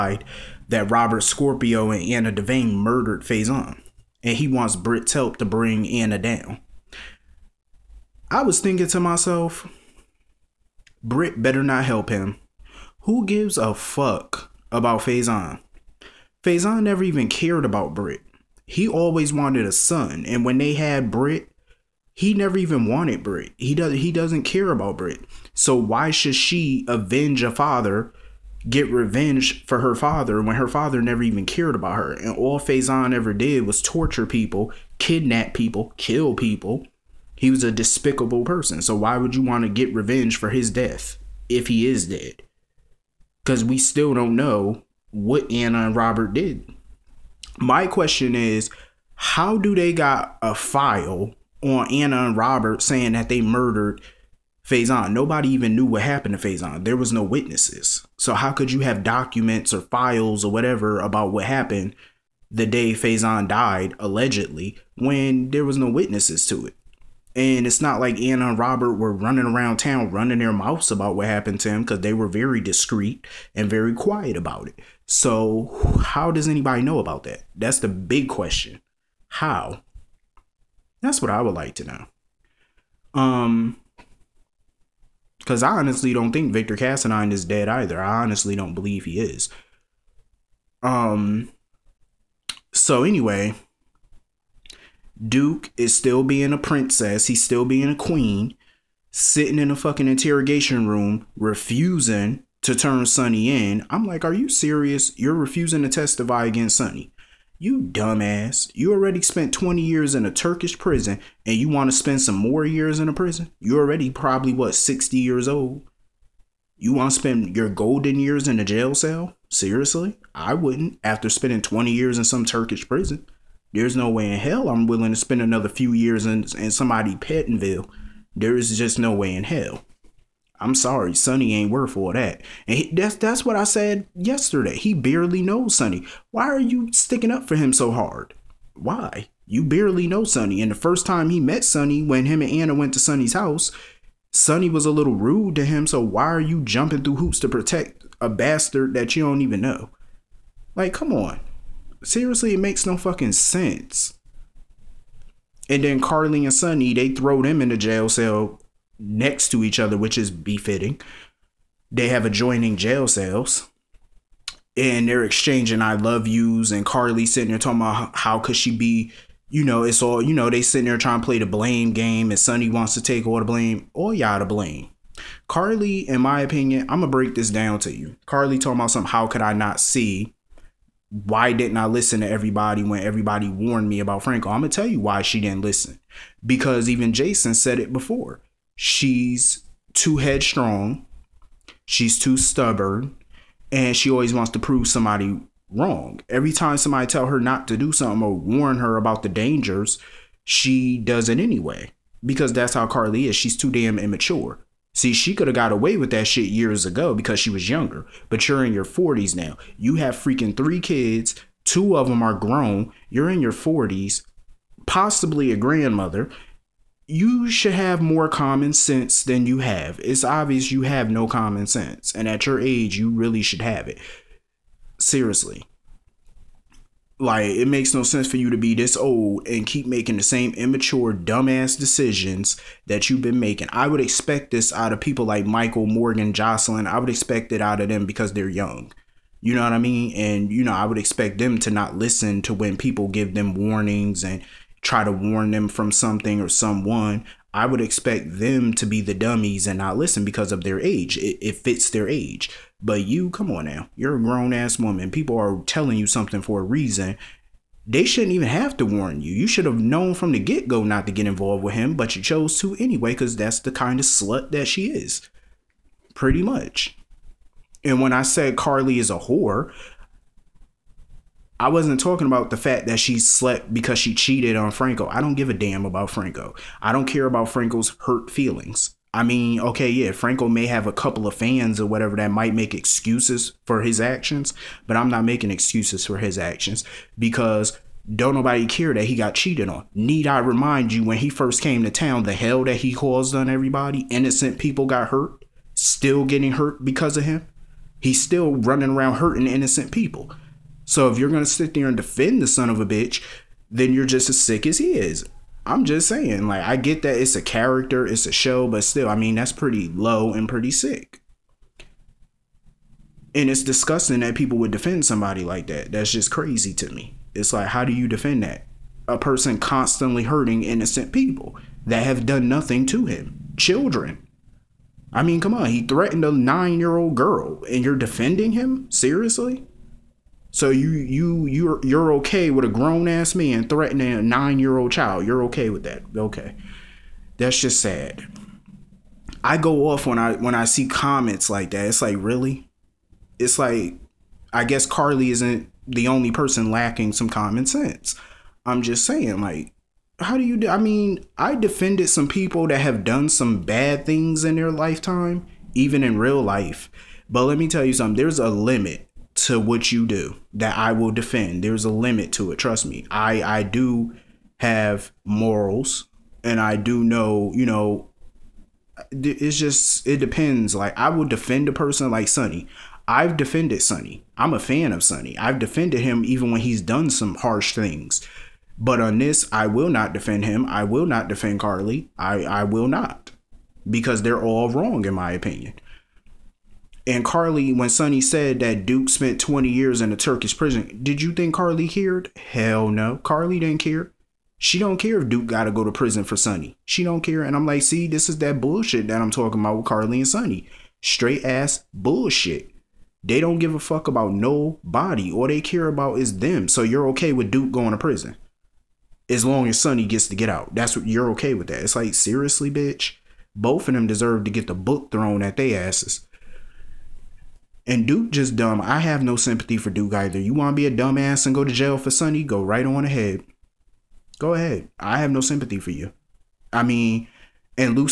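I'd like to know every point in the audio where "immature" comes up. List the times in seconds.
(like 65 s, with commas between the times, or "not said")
203 s, 230 s.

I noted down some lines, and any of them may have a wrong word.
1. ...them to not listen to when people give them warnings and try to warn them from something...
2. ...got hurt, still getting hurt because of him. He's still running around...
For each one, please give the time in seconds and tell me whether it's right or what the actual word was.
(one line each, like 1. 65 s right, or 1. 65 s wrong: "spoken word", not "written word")
1. 241 s right
2. 294 s right.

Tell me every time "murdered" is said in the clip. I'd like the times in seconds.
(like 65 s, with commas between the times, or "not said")
2 s, 53 s.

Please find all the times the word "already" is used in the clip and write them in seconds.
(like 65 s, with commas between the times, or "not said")
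108 s, 113 s.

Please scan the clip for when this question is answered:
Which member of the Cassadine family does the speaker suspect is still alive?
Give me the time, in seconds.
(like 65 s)
86 s.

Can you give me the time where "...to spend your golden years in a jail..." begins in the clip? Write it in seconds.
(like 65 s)
117 s.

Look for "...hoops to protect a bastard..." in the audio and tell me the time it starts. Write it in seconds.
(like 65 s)
147 s.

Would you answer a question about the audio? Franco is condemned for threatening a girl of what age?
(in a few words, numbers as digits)
9.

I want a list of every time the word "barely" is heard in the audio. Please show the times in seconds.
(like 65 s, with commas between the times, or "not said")
134 s, 139 s.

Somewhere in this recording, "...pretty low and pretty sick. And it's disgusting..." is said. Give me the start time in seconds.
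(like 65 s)
309 s.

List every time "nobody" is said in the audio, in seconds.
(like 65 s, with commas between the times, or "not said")
55 s, 288 s, 404 s.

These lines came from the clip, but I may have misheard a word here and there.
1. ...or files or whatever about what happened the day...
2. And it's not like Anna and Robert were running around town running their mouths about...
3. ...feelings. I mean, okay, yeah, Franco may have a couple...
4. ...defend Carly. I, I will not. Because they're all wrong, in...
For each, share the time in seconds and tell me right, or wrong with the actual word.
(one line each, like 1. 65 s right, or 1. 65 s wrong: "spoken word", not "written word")
1. 59 s right
2. 67 s right
3. 278 s right
4. 381 s right.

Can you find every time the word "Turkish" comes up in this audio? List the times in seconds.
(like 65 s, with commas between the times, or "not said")
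110 s, 122 s, 390 s.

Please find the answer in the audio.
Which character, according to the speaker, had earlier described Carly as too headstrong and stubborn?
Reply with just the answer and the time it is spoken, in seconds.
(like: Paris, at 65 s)
Jason, at 187 s.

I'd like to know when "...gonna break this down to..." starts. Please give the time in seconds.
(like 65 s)
177 s.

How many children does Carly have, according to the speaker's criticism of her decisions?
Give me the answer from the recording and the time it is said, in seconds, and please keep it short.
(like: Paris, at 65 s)
3, at 210 s.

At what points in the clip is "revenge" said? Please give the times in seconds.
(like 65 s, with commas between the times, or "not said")
28 s, 39 s.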